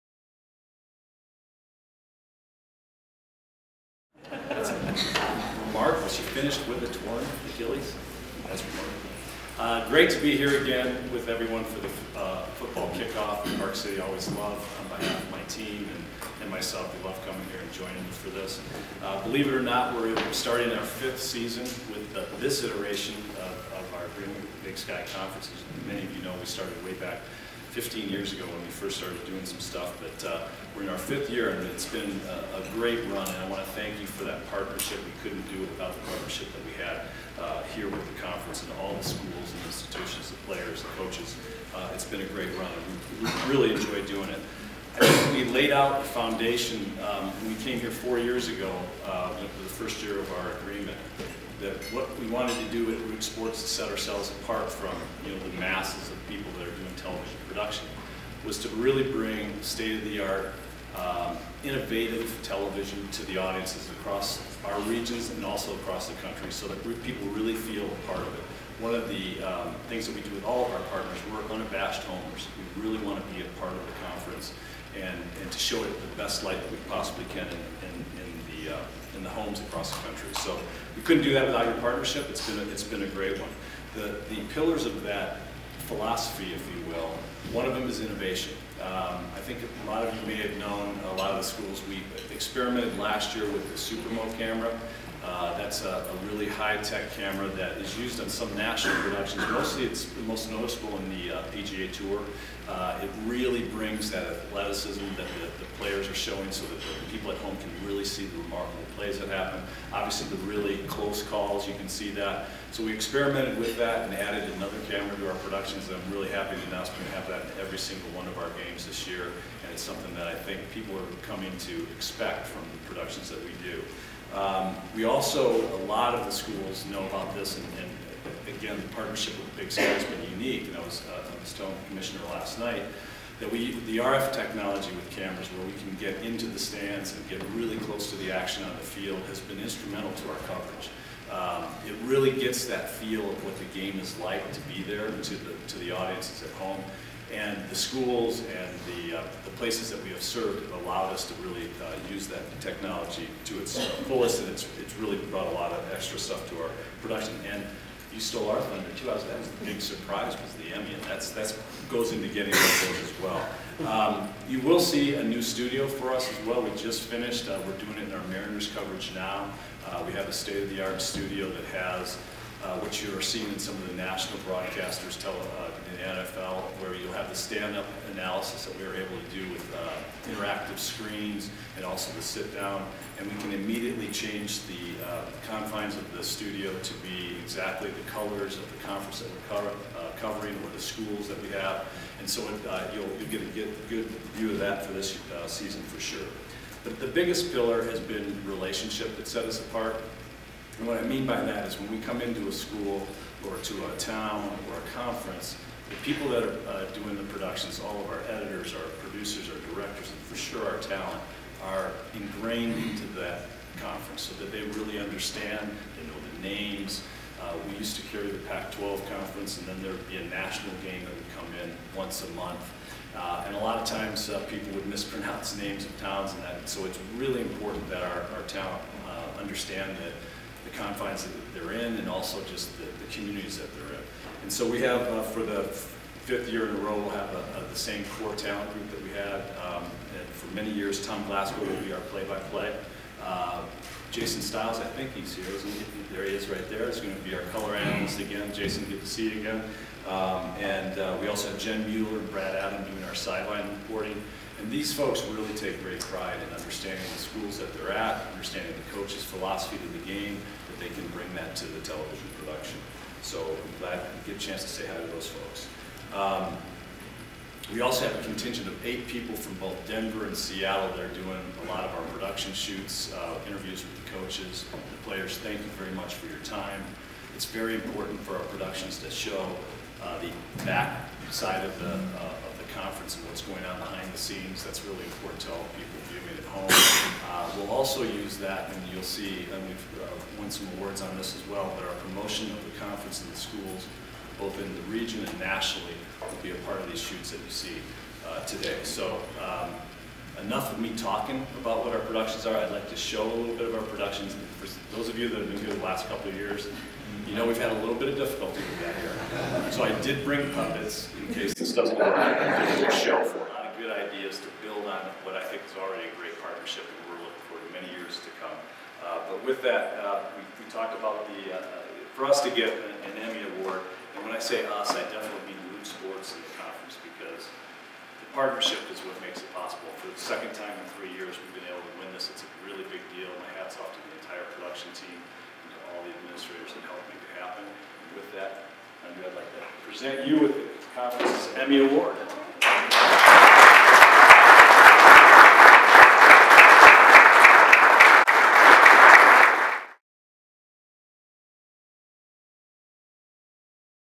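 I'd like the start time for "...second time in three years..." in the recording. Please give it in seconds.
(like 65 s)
330 s.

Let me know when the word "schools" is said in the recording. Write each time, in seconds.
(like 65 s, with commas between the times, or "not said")
39 s, 91 s, 126 s, 147 s, 190 s, 202 s, 257 s, 293 s.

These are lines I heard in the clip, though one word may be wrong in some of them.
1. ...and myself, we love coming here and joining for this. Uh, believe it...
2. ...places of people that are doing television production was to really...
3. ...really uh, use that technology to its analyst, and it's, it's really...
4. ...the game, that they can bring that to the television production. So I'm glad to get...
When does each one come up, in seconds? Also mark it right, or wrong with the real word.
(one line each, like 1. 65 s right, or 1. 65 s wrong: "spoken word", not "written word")
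1. 16 s right
2. 55 s wrong: "masses", not "places"
3. 151 s wrong: "fullest", not "analyst"
4. 259 s right.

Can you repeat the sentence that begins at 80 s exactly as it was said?
So we couldn't do that without your partnership.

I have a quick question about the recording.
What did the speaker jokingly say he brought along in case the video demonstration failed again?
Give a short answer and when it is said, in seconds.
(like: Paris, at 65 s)
puppets, at 310 s.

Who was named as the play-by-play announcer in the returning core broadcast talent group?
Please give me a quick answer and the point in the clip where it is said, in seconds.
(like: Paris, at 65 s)
Tom Glasgow, at 241 s.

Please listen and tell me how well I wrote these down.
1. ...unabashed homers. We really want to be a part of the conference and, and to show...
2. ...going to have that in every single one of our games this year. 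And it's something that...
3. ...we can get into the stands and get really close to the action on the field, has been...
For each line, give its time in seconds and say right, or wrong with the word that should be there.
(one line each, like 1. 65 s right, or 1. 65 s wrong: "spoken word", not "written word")
1. 71 s right
2. 117 s right
3. 135 s right.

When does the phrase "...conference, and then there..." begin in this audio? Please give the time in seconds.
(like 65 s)
219 s.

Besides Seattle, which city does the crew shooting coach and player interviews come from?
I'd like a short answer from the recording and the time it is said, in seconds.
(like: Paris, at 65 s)
Denver, at 269 s.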